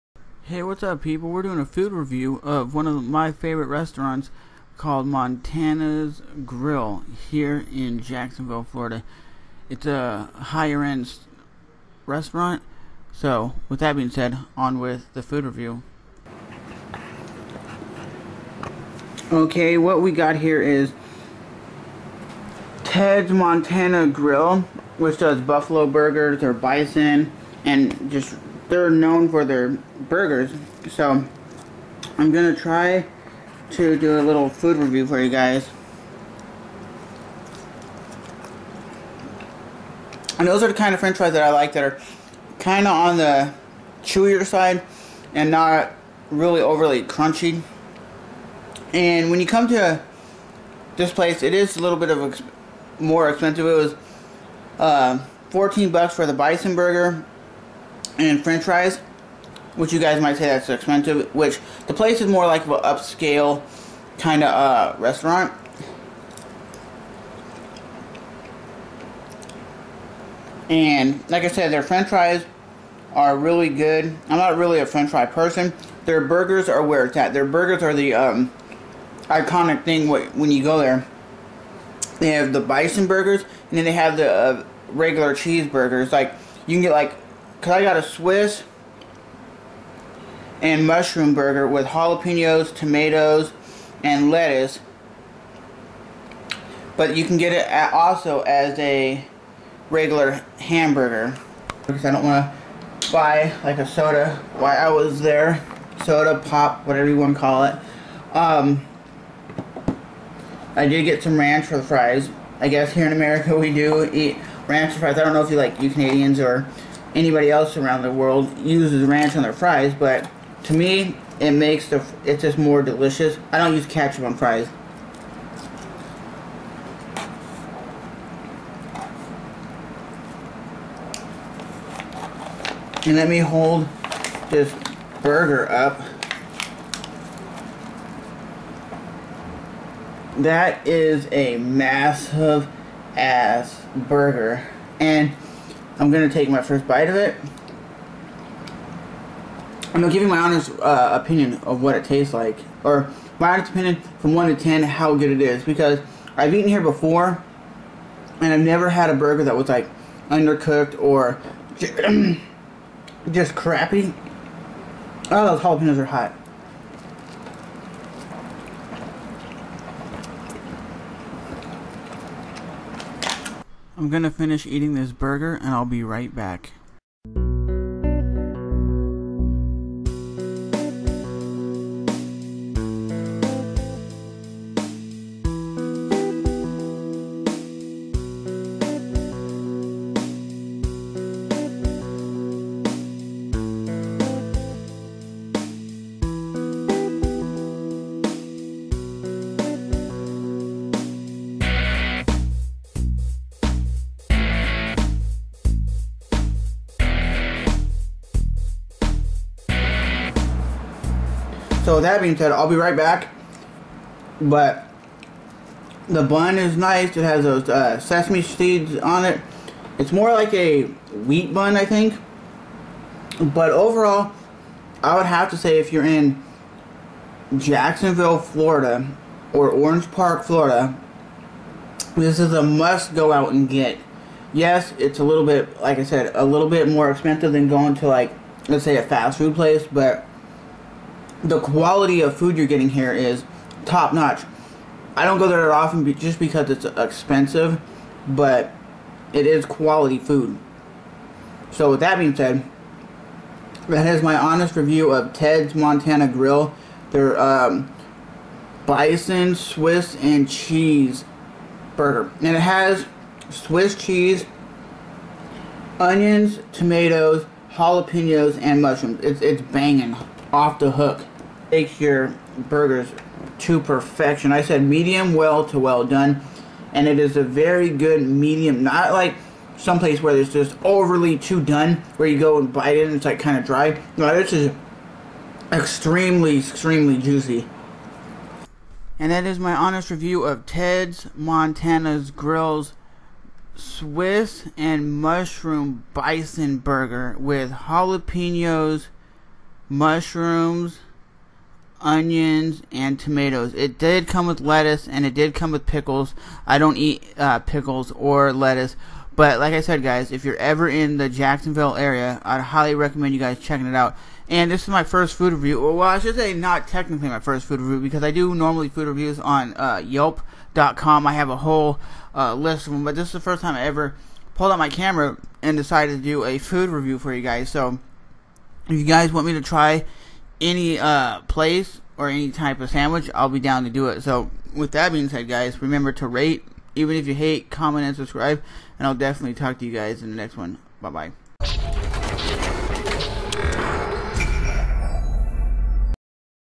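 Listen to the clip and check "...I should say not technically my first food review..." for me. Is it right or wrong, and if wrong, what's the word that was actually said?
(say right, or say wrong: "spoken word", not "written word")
right.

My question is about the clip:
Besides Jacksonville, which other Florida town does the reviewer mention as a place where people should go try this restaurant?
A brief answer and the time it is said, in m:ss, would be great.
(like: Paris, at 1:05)
Orange Park, at 3:49.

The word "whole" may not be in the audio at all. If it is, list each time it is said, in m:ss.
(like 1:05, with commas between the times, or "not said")
5:21.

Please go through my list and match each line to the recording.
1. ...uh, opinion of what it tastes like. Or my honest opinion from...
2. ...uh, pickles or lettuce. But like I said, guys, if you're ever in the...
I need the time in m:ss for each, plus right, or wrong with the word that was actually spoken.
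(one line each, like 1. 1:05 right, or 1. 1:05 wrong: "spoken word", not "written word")
1. 2:30 right
2. 5:07 right.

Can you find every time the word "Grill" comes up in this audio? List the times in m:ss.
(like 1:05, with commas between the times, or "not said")
0:06, 0:24, 4:16, 4:52.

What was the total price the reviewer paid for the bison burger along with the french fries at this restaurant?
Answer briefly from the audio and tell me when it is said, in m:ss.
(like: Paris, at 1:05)
$14, at 0:55.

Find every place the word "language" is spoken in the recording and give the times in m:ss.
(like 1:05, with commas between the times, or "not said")
not said.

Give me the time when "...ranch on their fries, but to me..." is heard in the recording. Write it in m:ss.
1:59.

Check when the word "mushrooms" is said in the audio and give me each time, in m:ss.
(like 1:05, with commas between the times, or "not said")
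1:30, 4:28, 4:55, 4:59.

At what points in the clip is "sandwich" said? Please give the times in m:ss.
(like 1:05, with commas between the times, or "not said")
5:32.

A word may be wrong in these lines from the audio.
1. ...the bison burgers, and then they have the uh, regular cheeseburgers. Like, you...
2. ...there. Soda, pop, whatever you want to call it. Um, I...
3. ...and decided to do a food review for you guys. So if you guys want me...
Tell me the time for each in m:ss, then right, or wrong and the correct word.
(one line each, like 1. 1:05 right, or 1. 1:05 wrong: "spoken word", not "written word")
1. 1:22 right
2. 1:45 right
3. 5:25 right.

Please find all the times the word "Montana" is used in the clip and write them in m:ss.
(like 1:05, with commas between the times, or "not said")
0:05, 0:23, 4:15, 4:51.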